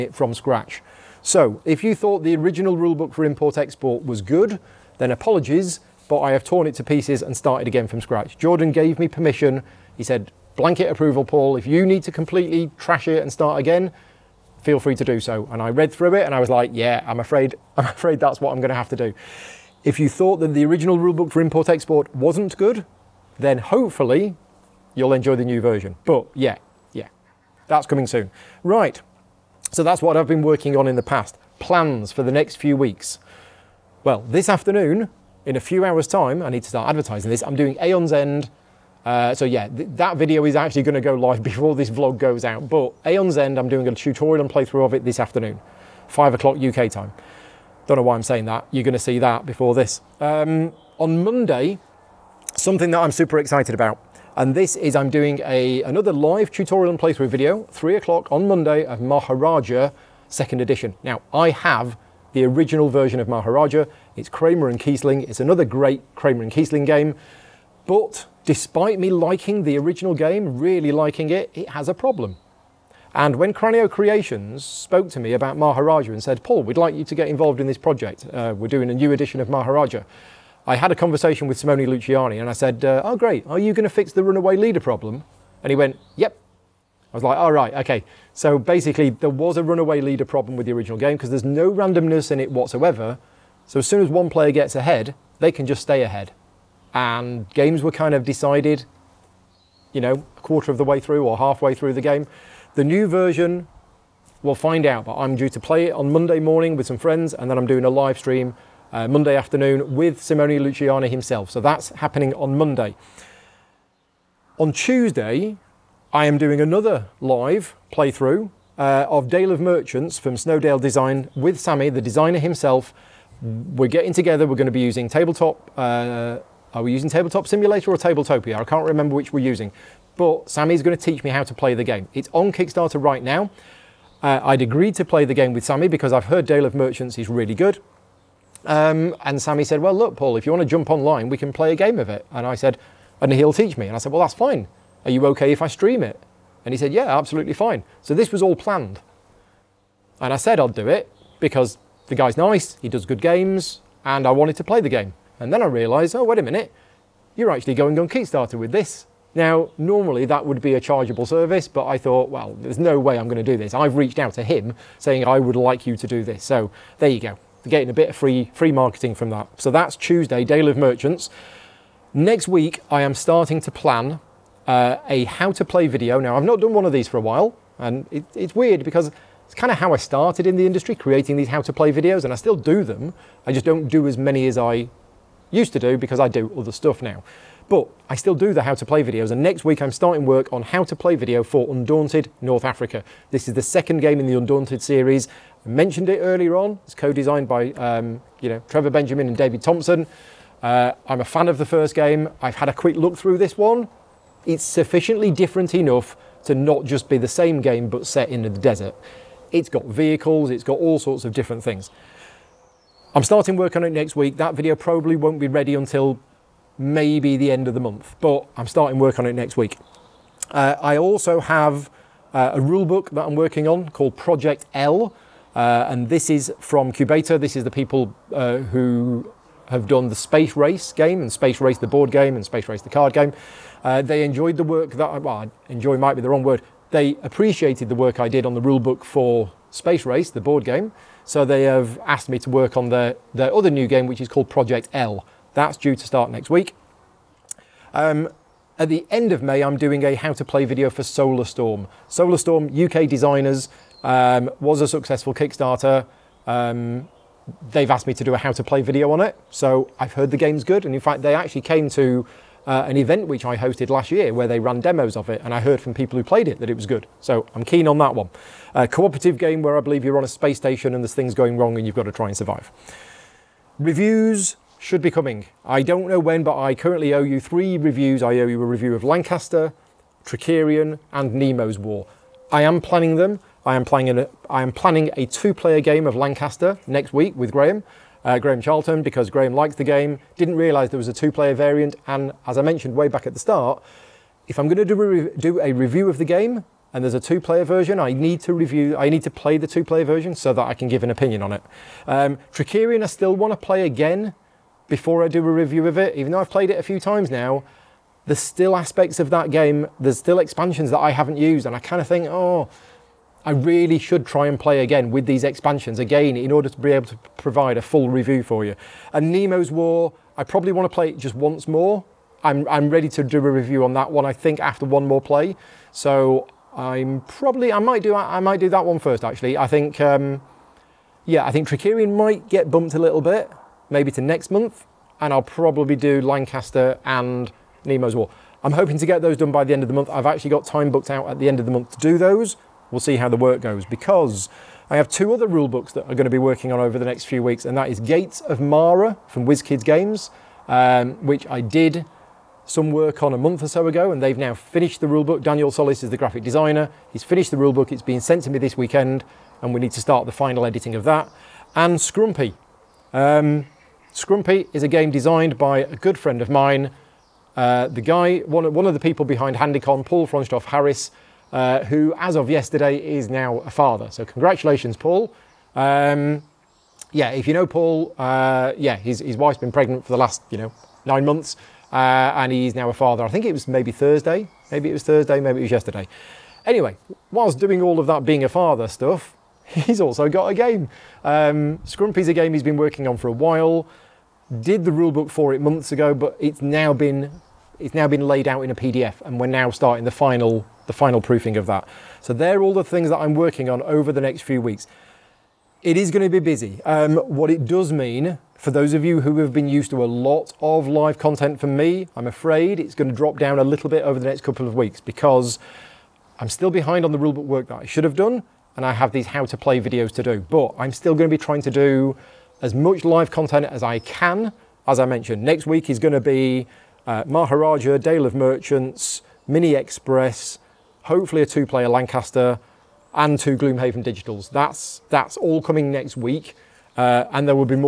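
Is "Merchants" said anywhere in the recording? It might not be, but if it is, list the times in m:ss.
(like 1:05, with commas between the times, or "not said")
1:59, 2:16, 2:50, 7:08.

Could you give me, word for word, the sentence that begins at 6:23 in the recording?
I think it was maybe Thursday, maybe it was Thursday, maybe it was yesterday.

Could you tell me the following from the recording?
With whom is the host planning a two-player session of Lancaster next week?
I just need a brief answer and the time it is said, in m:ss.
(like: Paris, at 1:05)
Graham Charlton, at 4:48.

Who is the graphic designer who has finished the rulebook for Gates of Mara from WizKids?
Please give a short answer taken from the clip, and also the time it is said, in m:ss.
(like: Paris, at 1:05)
Daniel Solis, at 5:55.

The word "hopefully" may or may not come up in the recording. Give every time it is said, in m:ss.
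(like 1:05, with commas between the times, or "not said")
0:23, 7:11.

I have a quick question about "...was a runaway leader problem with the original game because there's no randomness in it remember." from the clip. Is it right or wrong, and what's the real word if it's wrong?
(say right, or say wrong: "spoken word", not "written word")
wrong: "whatsoever", not "remember".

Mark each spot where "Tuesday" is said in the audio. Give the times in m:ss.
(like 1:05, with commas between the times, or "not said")
1:54, 2:49.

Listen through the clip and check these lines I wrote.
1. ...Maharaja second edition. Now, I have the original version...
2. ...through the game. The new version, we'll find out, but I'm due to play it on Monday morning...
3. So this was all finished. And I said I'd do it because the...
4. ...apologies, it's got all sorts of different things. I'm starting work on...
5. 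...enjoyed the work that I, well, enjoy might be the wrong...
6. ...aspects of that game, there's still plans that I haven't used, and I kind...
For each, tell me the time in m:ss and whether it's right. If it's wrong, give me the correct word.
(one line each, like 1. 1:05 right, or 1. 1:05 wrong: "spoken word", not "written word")
1. 0:58 right
2. 1:41 right
3. 2:28 wrong: "planned", not "finished"
4. 3:29 wrong: "vehicles", not "apologies"
5. 3:54 right
6. 5:08 wrong: "expansions", not "plans".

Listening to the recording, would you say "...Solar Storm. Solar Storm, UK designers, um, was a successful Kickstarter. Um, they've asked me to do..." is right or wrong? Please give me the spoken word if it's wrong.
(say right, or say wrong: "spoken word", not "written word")
right.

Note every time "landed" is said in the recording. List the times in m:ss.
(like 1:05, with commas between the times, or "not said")
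not said.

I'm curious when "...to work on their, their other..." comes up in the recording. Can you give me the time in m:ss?
4:02.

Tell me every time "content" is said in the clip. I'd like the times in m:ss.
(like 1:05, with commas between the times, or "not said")
6:51, 7:03.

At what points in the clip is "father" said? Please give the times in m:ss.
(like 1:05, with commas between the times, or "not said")
6:13, 6:22, 6:28.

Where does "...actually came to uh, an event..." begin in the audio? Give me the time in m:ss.
4:21.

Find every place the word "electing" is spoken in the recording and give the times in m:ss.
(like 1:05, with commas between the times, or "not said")
not said.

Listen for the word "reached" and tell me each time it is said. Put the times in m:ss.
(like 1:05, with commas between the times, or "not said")
2:43.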